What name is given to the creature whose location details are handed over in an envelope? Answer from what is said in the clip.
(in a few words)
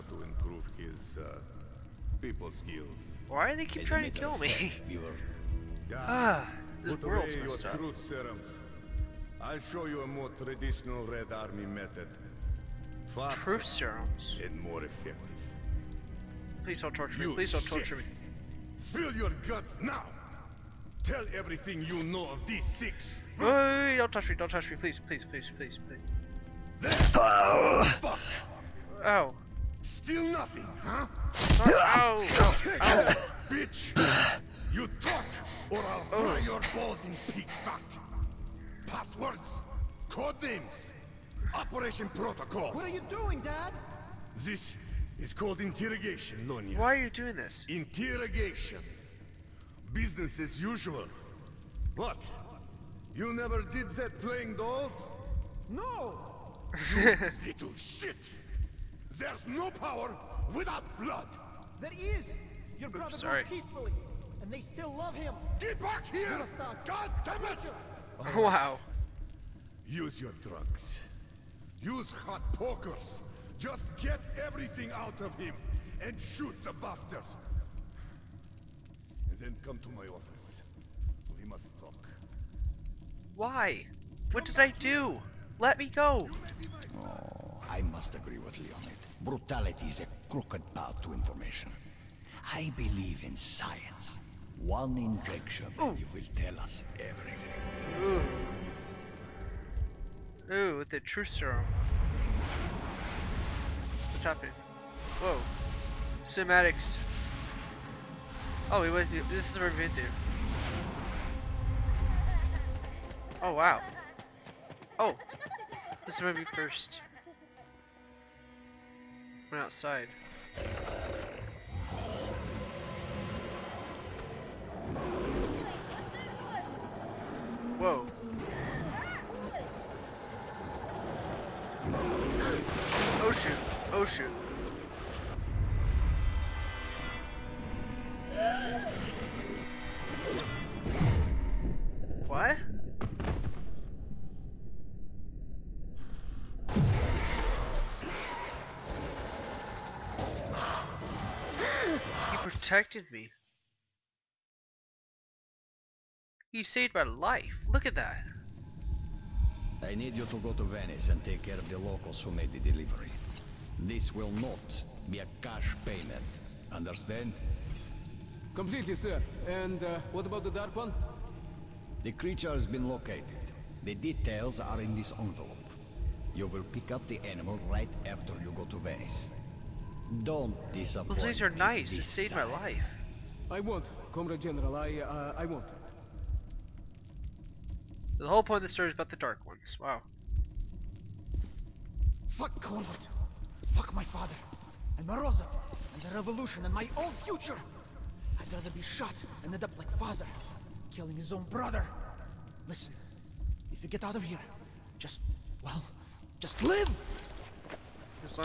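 the Dark One.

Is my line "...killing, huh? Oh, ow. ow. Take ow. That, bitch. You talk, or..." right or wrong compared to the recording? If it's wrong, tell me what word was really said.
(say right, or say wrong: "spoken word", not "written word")
wrong: "nothing", not "killing".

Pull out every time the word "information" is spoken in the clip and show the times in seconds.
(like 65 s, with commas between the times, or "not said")
91 s.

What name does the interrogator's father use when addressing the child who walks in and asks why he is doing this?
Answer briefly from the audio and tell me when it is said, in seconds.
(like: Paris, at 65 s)
Lonia, at 46 s.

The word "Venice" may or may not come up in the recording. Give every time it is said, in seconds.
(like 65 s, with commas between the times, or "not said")
160 s, 178 s.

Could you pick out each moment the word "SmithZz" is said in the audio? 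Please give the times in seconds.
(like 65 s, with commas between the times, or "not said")
not said.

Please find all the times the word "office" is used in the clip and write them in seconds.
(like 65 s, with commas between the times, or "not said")
80 s.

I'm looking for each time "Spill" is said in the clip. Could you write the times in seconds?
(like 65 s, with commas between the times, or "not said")
18 s.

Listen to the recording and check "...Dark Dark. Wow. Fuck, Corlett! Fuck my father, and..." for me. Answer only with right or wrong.
wrong.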